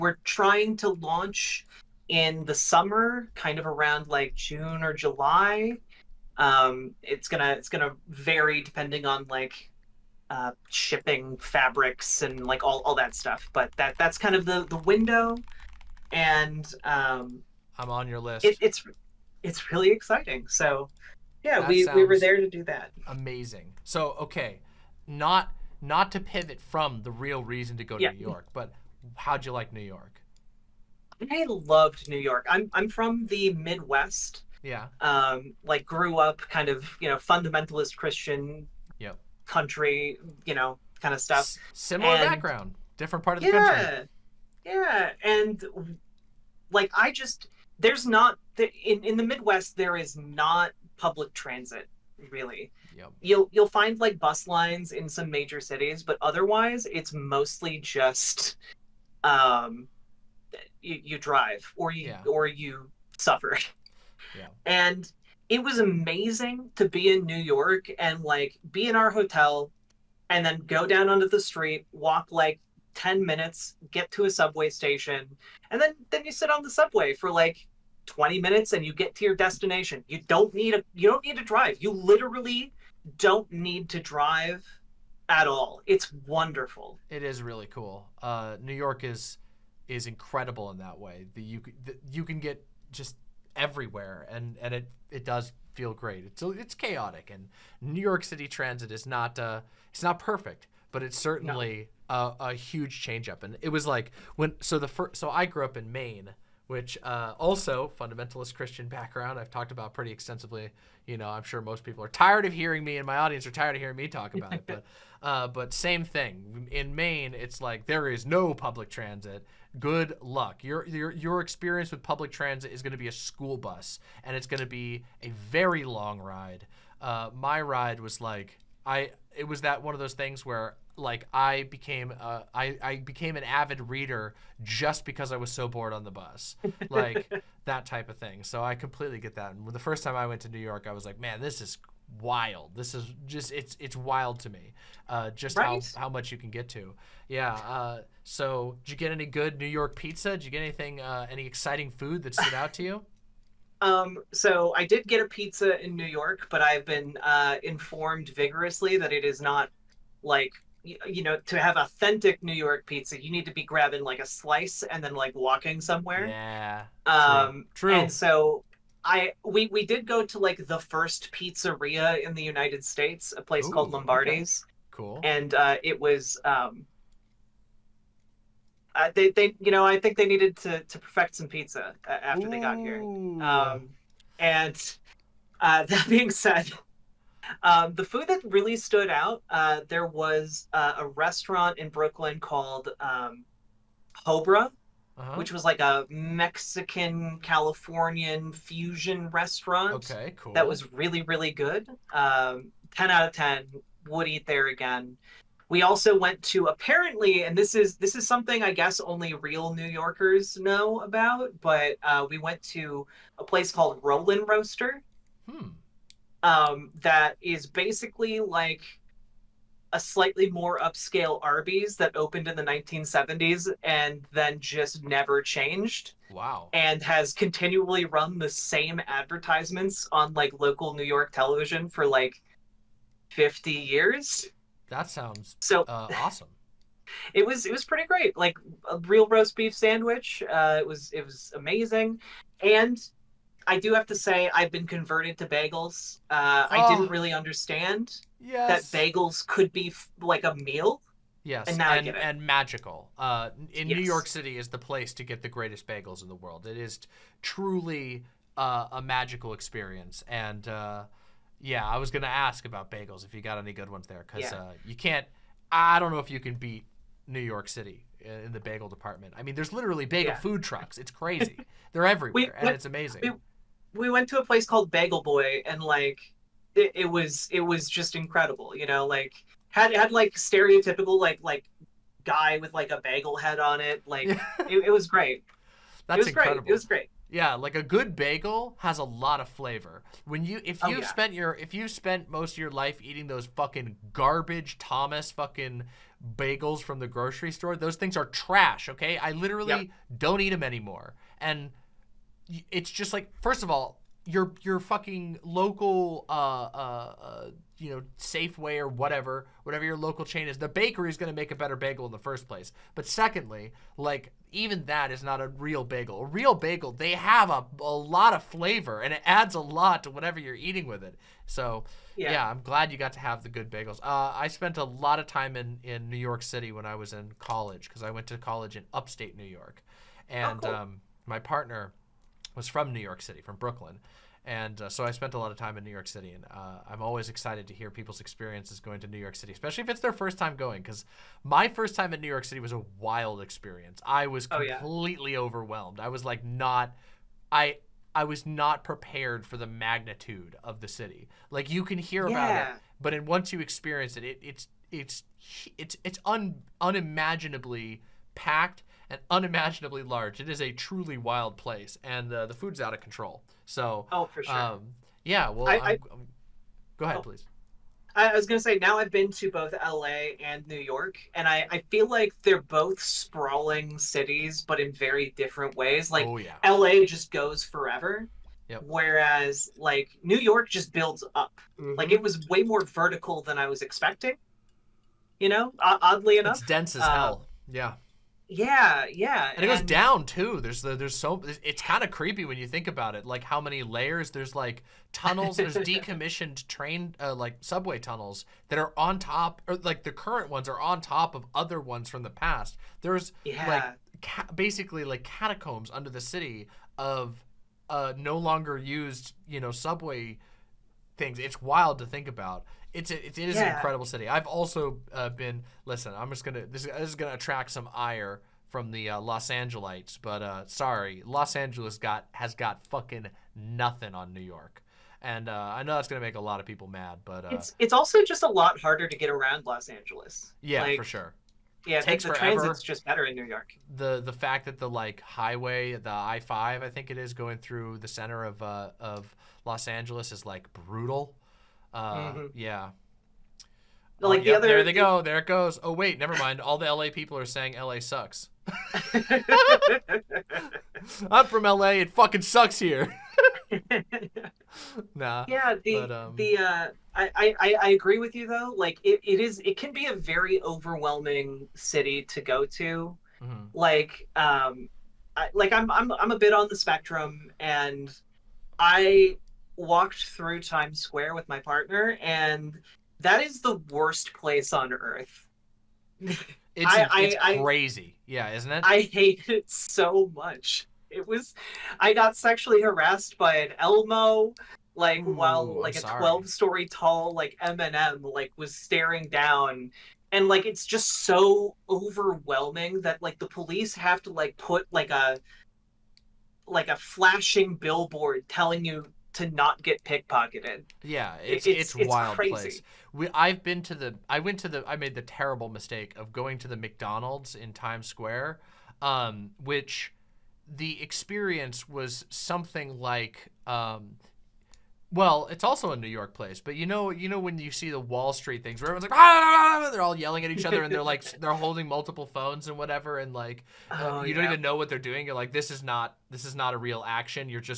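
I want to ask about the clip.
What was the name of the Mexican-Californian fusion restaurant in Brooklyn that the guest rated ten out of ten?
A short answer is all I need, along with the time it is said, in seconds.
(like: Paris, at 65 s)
Hobra, at 194 s.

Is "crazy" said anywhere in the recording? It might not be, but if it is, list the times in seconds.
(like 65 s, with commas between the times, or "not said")
271 s, 477 s, 502 s.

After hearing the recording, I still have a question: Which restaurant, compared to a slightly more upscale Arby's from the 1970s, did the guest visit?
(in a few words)
Roll-N-Roaster.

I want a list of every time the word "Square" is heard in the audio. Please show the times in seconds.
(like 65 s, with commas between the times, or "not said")
471 s, 508 s.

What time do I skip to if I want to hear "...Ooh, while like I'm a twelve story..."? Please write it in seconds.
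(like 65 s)
485 s.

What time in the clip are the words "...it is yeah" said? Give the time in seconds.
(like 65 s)
413 s.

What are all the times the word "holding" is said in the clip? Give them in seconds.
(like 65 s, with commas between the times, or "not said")
521 s.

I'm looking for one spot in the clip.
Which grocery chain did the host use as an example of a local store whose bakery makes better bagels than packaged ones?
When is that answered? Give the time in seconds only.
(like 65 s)
308 s.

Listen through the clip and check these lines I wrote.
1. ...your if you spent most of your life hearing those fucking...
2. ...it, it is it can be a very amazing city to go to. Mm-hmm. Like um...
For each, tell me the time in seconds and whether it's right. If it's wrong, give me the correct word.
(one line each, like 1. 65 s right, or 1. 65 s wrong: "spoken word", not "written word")
1. 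291 s wrong: "eating", not "hearing"
2. 459 s wrong: "overwhelming", not "amazing".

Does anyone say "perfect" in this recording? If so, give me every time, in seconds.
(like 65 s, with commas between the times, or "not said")
100 s, 180 s.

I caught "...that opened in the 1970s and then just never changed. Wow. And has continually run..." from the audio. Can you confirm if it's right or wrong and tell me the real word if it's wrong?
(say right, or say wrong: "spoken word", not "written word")
right.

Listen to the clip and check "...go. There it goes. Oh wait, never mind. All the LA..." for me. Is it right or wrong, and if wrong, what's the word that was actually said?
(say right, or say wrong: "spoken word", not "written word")
right.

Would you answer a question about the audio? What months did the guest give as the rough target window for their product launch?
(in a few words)
June or July.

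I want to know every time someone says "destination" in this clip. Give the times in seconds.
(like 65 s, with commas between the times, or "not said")
79 s.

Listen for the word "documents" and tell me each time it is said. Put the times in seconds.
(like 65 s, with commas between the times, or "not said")
not said.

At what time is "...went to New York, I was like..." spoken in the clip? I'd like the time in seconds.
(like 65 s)
140 s.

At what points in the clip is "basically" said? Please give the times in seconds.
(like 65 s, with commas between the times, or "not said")
217 s, 404 s.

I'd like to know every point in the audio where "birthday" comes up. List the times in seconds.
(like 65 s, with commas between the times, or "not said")
not said.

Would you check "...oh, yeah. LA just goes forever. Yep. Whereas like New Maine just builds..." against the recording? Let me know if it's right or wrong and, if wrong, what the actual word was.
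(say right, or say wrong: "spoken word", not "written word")
wrong: "York", not "Maine".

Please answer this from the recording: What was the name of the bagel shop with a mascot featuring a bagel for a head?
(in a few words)
Bagel Boy.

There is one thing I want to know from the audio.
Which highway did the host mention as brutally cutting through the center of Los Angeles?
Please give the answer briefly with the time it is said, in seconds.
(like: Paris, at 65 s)
I-5, at 436 s.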